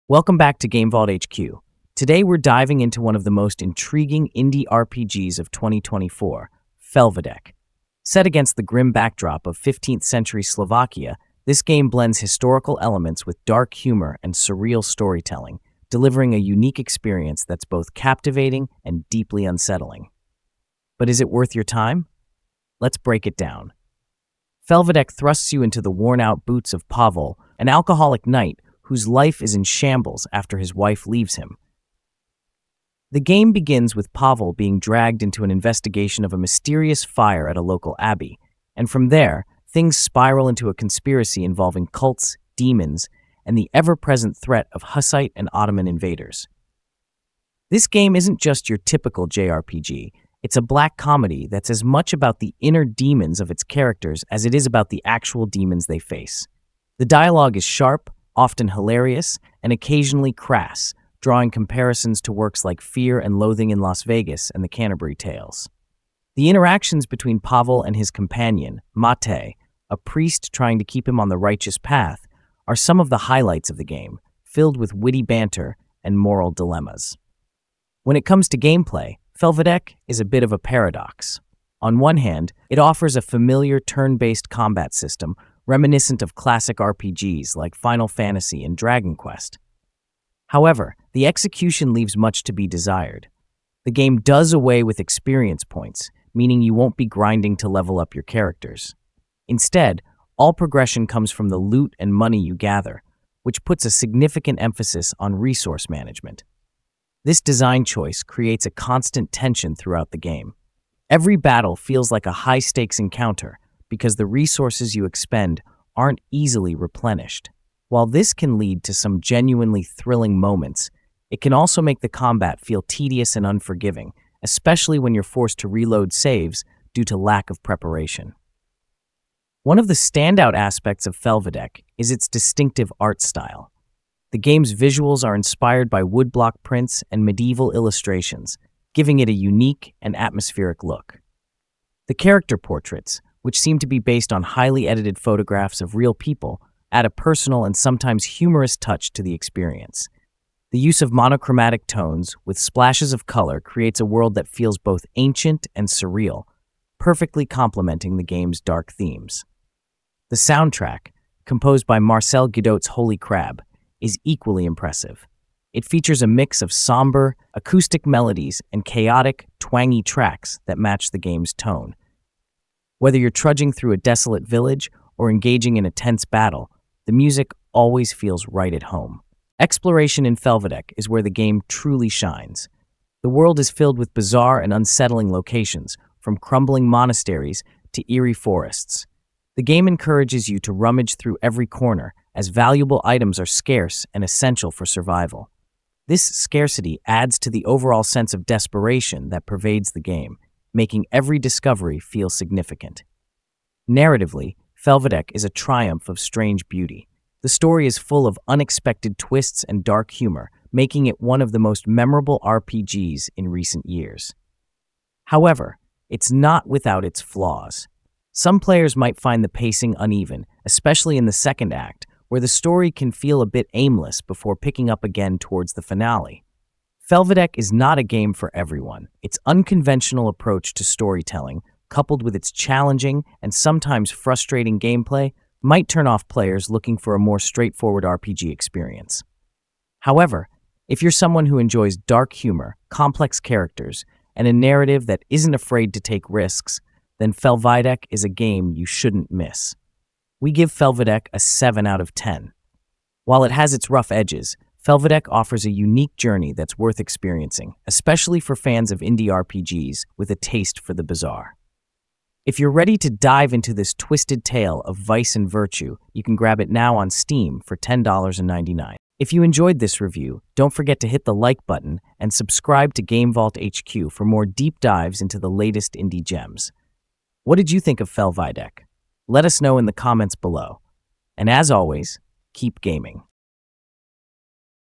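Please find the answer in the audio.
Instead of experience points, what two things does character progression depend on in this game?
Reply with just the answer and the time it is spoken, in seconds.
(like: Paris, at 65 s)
Loot and money, at 101 s.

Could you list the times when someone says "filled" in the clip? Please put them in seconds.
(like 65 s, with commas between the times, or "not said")
74 s, 183 s.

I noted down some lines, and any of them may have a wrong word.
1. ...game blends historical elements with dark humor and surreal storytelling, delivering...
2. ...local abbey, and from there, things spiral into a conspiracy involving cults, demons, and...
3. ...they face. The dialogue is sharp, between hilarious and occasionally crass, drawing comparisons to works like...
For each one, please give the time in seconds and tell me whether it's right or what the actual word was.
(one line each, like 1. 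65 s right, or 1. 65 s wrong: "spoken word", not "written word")
1. 11 s right
2. 37 s right
3. 55 s wrong: "often", not "between".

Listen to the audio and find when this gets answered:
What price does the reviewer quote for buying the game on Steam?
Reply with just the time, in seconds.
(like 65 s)
267 s.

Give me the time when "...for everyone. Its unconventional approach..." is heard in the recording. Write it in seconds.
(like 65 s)
228 s.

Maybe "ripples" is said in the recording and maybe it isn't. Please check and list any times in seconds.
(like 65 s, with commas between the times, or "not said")
not said.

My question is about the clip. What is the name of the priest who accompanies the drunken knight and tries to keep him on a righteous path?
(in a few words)
Mate.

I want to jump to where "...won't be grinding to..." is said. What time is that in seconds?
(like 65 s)
96 s.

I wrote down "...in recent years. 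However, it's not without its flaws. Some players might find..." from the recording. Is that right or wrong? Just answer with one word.
right.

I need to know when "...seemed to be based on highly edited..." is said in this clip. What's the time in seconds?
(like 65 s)
143 s.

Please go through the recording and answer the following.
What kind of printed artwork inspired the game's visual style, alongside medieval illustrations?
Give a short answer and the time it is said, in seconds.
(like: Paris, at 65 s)
Woodblock prints, at 136 s.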